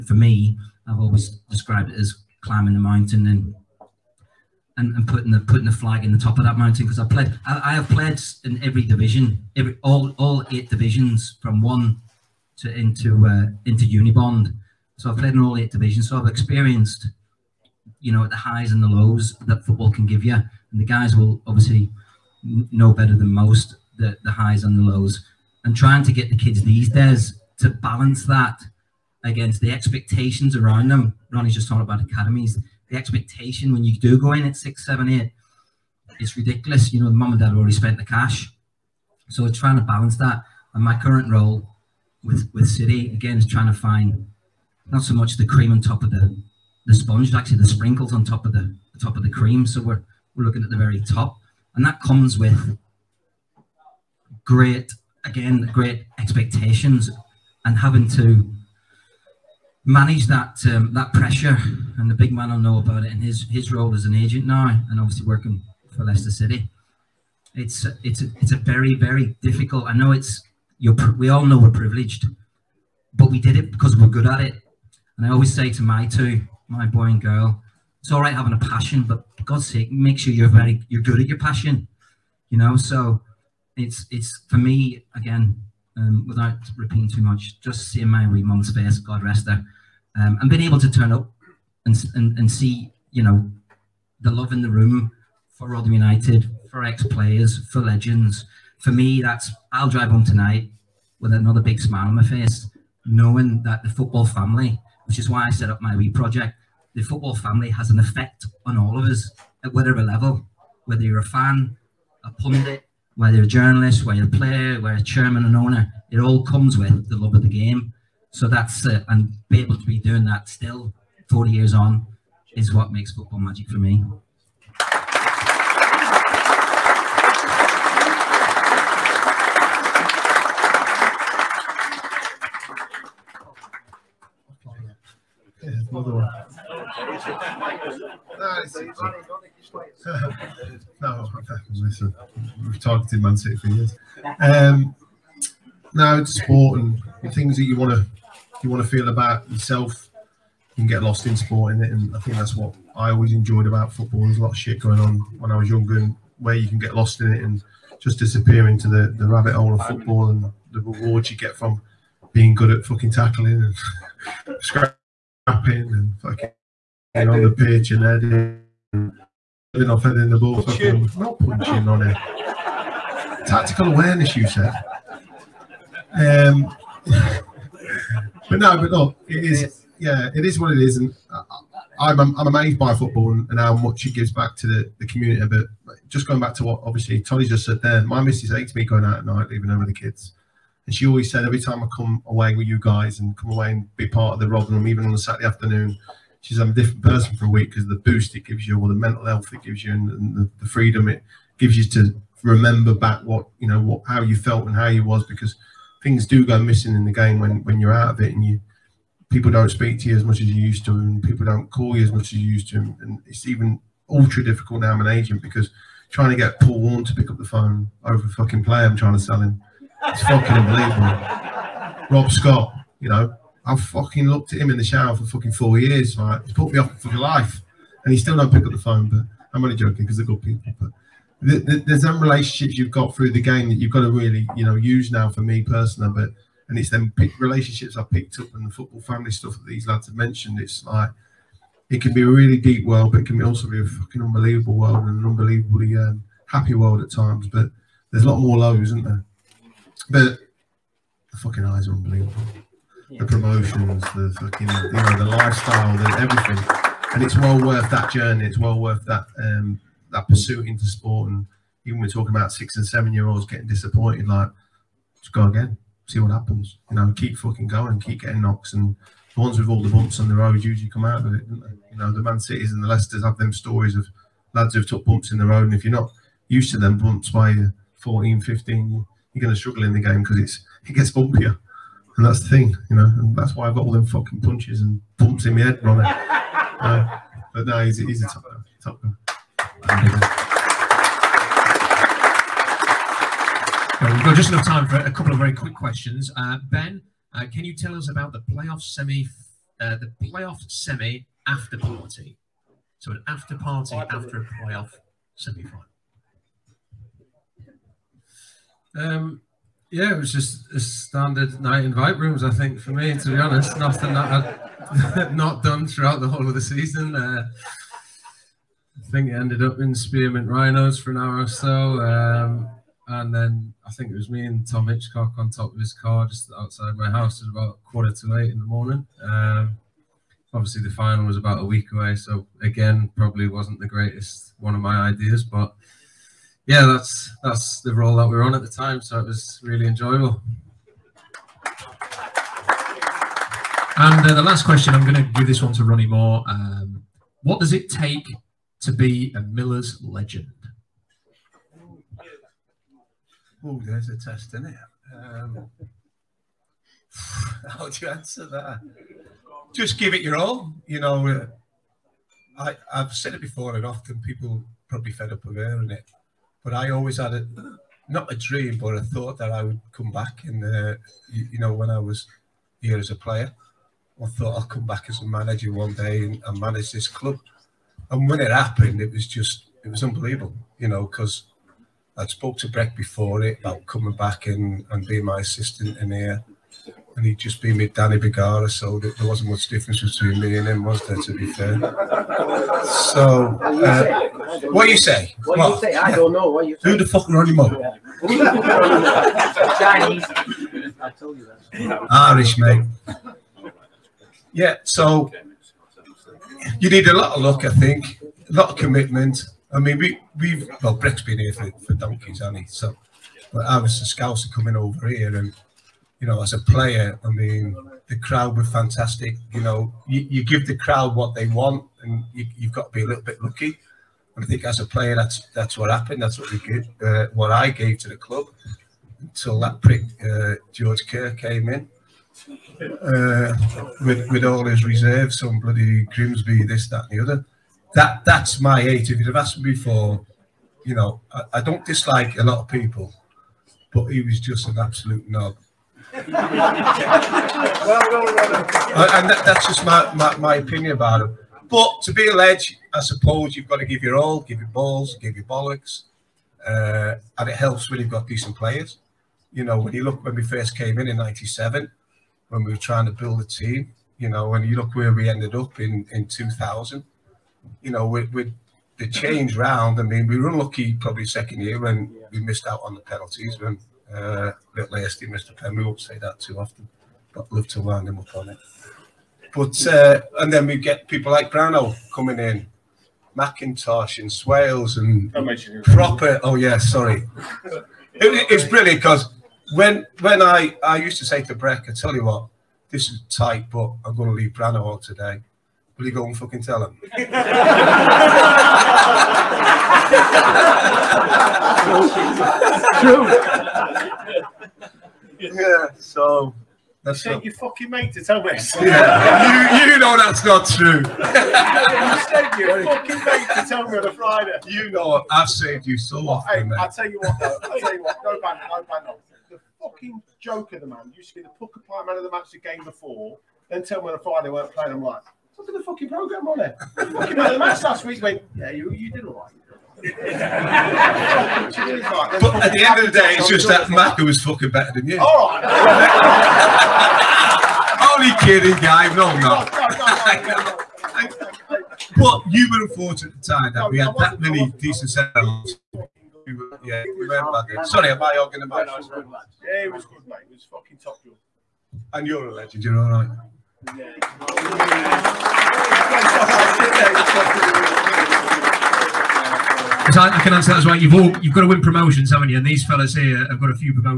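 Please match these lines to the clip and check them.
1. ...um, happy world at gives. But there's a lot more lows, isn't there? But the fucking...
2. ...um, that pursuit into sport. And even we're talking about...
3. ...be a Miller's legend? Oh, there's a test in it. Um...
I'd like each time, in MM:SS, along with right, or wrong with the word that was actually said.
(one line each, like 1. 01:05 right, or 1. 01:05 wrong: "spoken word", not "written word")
1. 04:05 wrong: "times", not "gives"
2. 04:19 right
3. 05:48 right.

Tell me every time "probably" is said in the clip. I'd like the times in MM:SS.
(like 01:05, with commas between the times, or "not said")
05:33, 06:04, 07:50.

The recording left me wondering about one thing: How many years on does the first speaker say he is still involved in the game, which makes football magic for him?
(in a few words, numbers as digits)
40.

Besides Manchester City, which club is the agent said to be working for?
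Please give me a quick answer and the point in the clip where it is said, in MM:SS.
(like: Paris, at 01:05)
Leicester City, at 01:06.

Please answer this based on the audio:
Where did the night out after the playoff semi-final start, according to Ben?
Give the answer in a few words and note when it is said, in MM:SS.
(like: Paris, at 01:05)
Vibe rooms, at 05:11.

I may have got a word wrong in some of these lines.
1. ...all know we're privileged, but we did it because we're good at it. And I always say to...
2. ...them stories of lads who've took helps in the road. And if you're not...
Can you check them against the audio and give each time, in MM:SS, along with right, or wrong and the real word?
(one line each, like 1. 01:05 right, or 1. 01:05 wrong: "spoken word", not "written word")
1. 01:11 right
2. 04:33 wrong: "bumps", not "helps".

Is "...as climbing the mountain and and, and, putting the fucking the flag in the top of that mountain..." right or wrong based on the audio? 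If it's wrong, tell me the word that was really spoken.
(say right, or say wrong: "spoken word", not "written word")
wrong: "putting", not "fucking".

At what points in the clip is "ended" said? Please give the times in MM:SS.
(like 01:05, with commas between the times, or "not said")
05:19, 07:45.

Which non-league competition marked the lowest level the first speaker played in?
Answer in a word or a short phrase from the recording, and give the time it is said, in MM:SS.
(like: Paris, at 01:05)
Unibond, at 00:13.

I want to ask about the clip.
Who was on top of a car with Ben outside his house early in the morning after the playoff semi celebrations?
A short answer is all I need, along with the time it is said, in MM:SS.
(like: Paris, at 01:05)
Tom Hitchcock, at 05:24.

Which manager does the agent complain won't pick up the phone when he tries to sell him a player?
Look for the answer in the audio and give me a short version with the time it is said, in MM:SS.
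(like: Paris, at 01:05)
Paul Warne, at 03:36.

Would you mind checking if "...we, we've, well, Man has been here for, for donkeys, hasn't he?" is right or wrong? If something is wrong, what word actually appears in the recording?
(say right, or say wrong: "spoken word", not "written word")
wrong: "Breck", not "Man".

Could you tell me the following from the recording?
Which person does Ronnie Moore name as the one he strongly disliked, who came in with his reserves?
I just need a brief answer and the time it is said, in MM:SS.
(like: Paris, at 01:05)
George Kerr, at 07:10.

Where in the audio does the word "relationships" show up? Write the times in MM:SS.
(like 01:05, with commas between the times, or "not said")
03:52, 03:57.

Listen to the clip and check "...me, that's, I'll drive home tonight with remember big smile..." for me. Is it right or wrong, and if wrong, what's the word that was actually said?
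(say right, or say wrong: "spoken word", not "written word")
wrong: "another", not "remember".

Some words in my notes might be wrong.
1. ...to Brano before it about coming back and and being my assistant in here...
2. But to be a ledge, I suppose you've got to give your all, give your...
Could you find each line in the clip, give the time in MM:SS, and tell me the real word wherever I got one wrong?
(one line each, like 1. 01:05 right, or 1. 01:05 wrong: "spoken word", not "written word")
1. 06:22 wrong: "Breck", not "Brano"
2. 07:31 right.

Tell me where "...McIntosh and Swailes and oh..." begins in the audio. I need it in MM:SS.
08:03.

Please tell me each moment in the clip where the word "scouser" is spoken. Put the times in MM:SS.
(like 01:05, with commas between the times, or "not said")
06:54.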